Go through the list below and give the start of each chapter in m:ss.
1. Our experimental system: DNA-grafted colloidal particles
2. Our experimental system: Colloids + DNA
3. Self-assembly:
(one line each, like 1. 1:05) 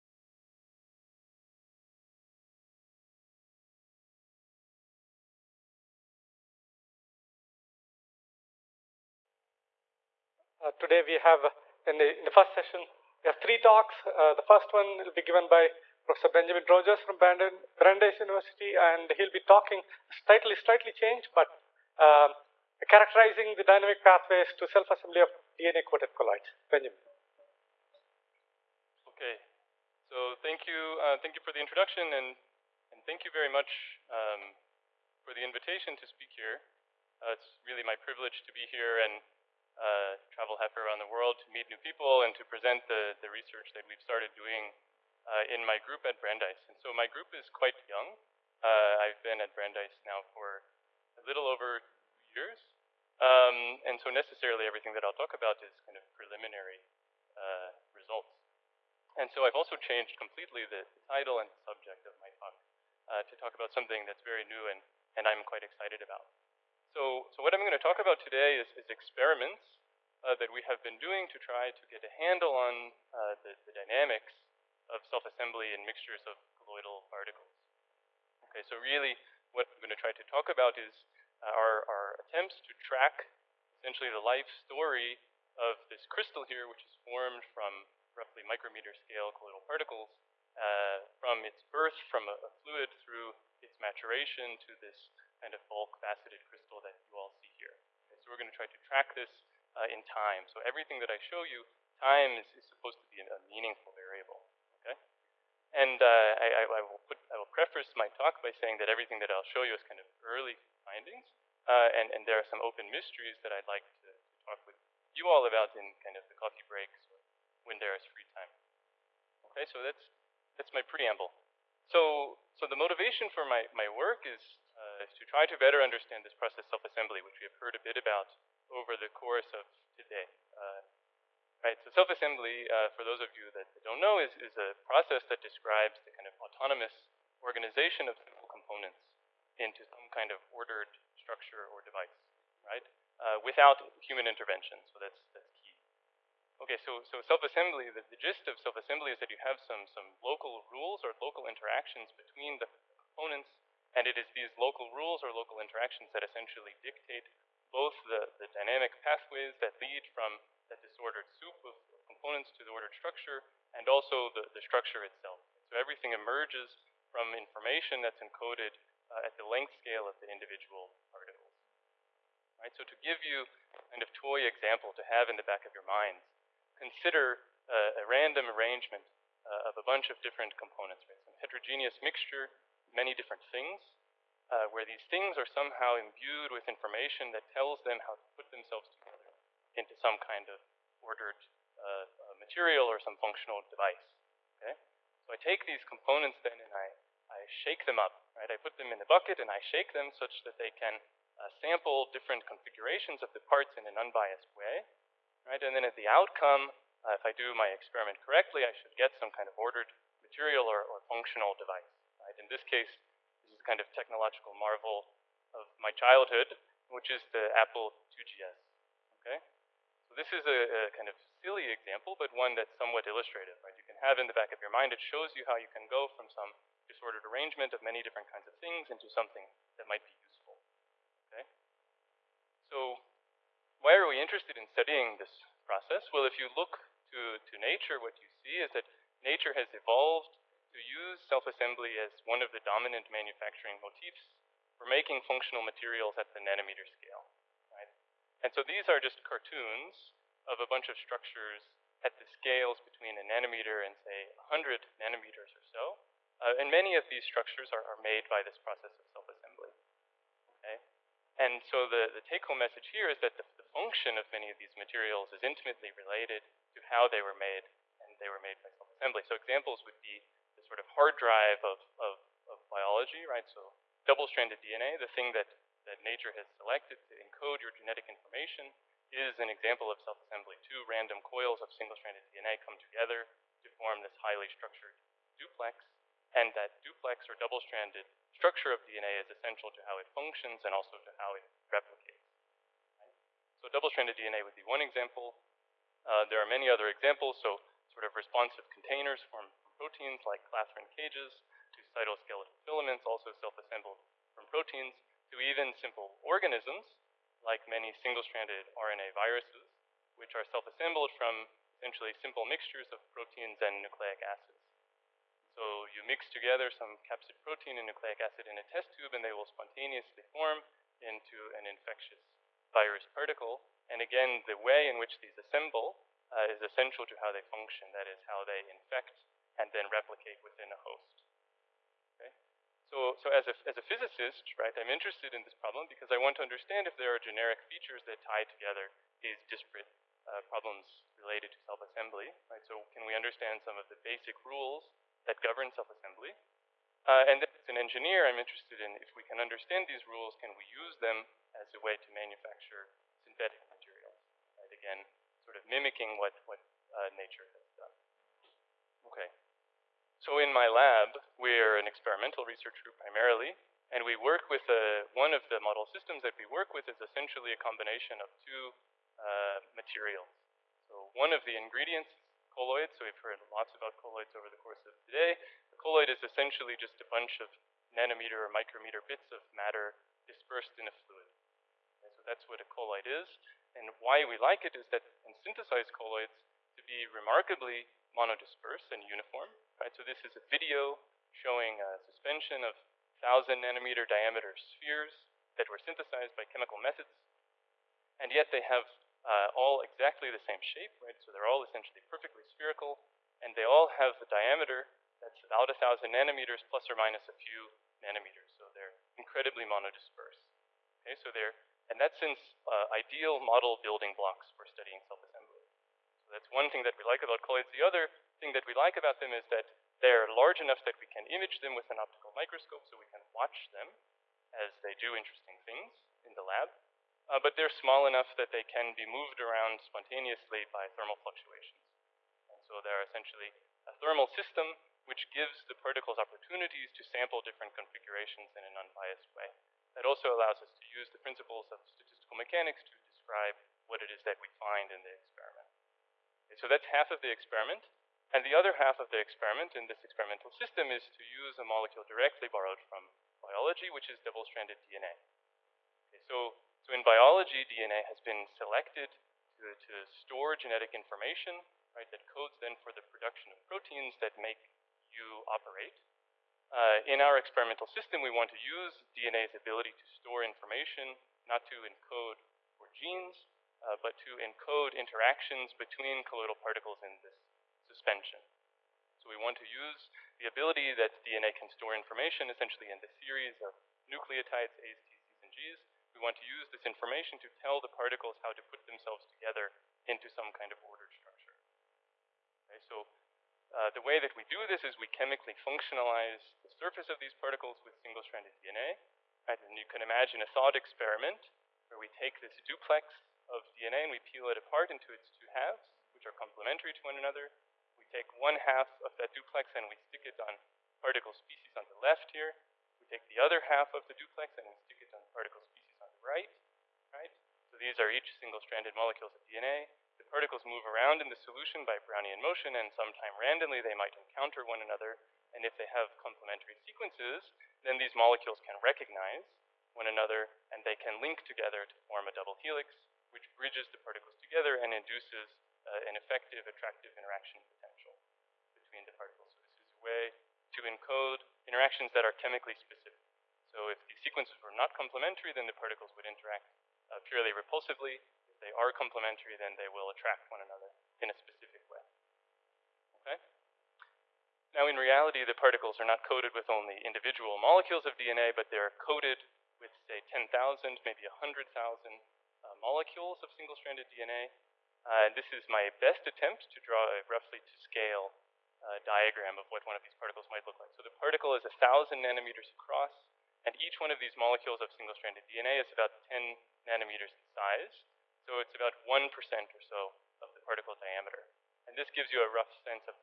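1. 9:14
2. 5:58
3. 2:01.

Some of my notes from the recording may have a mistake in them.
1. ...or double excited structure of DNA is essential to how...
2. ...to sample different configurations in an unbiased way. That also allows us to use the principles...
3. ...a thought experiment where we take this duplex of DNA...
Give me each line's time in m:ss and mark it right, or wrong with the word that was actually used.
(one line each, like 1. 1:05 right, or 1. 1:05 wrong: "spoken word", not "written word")
1. 4:47 wrong: "stranded", not "excited"
2. 7:16 right
3. 8:20 right.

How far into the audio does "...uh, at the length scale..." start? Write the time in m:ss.
2:49.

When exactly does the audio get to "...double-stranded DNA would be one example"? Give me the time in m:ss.
4:53.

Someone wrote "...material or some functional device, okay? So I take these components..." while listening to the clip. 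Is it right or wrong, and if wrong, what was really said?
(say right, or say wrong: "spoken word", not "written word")
right.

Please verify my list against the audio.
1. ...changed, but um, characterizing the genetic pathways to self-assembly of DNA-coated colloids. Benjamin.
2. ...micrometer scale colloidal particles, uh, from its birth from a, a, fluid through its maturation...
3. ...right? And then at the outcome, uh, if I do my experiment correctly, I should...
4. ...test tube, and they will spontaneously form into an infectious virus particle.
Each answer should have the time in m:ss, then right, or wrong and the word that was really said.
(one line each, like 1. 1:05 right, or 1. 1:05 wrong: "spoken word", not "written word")
1. 0:20 wrong: "dynamic", not "genetic"
2. 1:28 right
3. 3:25 right
4. 5:18 right.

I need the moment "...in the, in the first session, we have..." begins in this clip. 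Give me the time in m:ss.
0:11.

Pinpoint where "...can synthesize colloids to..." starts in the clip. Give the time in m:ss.
6:25.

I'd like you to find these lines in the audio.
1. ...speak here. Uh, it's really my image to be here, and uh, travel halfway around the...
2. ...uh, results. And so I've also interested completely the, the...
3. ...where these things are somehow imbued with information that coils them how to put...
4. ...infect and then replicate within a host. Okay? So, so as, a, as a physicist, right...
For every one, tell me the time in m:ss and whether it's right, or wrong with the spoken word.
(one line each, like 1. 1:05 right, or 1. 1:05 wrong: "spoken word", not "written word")
1. 0:36 wrong: "privilege", not "image"
2. 0:57 wrong: "changed", not "interested"
3. 3:04 wrong: "tells", not "coils"
4. 5:28 right.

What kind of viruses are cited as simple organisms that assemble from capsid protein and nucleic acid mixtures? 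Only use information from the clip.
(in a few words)
single-stranded RNA viruses.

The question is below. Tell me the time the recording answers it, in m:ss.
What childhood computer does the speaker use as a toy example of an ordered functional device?
3:37.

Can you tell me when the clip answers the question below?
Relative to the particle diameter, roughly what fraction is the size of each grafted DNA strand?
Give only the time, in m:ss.
9:39.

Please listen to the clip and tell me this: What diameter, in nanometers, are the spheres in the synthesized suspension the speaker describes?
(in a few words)
1,000 nanometers.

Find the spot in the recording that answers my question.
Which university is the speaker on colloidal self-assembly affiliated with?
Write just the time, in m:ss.
0:17.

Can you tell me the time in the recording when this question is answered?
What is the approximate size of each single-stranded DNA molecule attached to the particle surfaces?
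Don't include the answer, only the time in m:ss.
9:36.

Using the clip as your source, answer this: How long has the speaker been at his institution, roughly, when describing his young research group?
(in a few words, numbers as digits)
a little over two years.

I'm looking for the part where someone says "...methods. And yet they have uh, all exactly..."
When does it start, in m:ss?
6:36.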